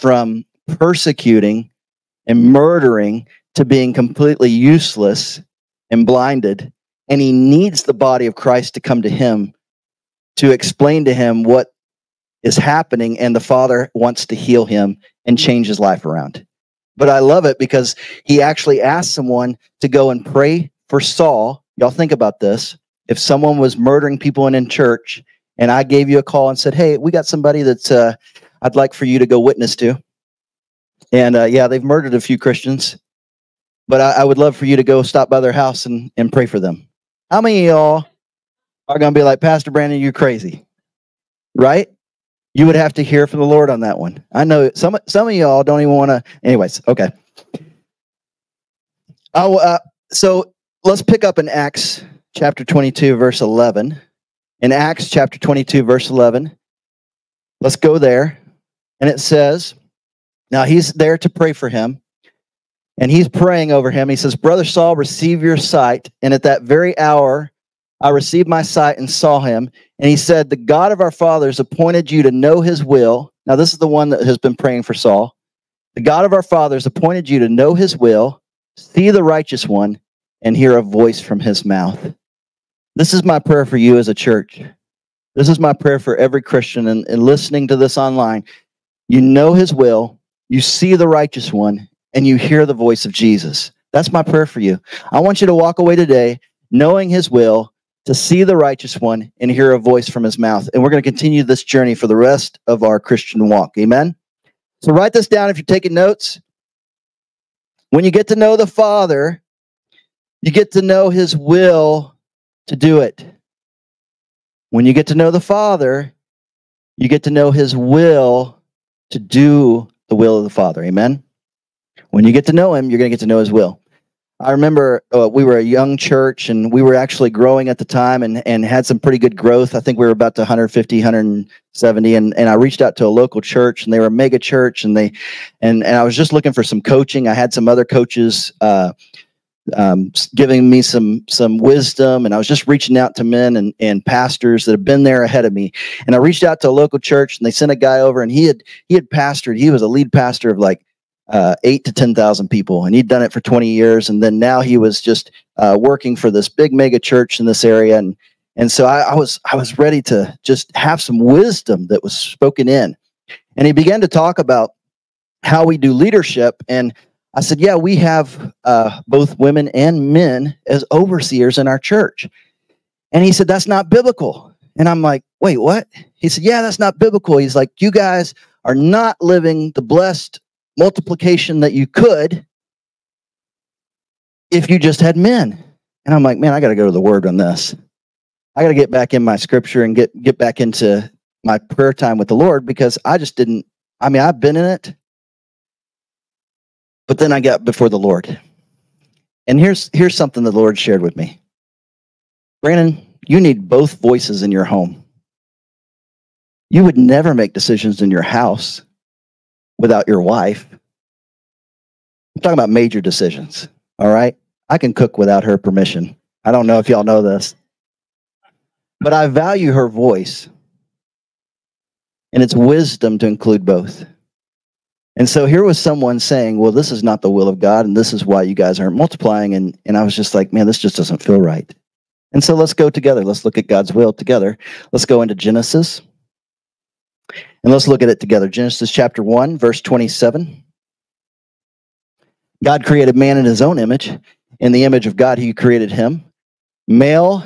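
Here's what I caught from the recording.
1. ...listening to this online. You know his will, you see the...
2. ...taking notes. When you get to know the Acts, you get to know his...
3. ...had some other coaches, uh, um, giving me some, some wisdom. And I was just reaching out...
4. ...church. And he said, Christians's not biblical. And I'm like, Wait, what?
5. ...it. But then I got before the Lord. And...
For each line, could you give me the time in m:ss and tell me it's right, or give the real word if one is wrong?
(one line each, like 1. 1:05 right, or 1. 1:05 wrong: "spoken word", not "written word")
1. 1:27 right
2. 1:45 wrong: "Father", not "Acts"
3. 2:17 right
4. 2:51 wrong: "That", not "Christians"
5. 3:14 right.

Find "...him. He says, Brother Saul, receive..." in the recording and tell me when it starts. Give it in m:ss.
1:03.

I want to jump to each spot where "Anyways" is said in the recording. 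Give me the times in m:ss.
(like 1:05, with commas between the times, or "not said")
0:46.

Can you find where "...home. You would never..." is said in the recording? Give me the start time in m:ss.
3:24.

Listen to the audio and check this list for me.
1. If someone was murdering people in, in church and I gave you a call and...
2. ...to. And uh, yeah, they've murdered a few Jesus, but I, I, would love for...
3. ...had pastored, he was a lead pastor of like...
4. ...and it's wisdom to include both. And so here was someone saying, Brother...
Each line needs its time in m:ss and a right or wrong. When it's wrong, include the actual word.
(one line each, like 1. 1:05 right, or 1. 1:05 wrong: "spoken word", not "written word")
1. 0:23 right
2. 0:29 wrong: "Christians", not "Jesus"
3. 2:28 right
4. 3:42 wrong: "Well", not "Brother".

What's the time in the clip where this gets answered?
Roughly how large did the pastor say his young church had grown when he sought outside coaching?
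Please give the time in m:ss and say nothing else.
2:10.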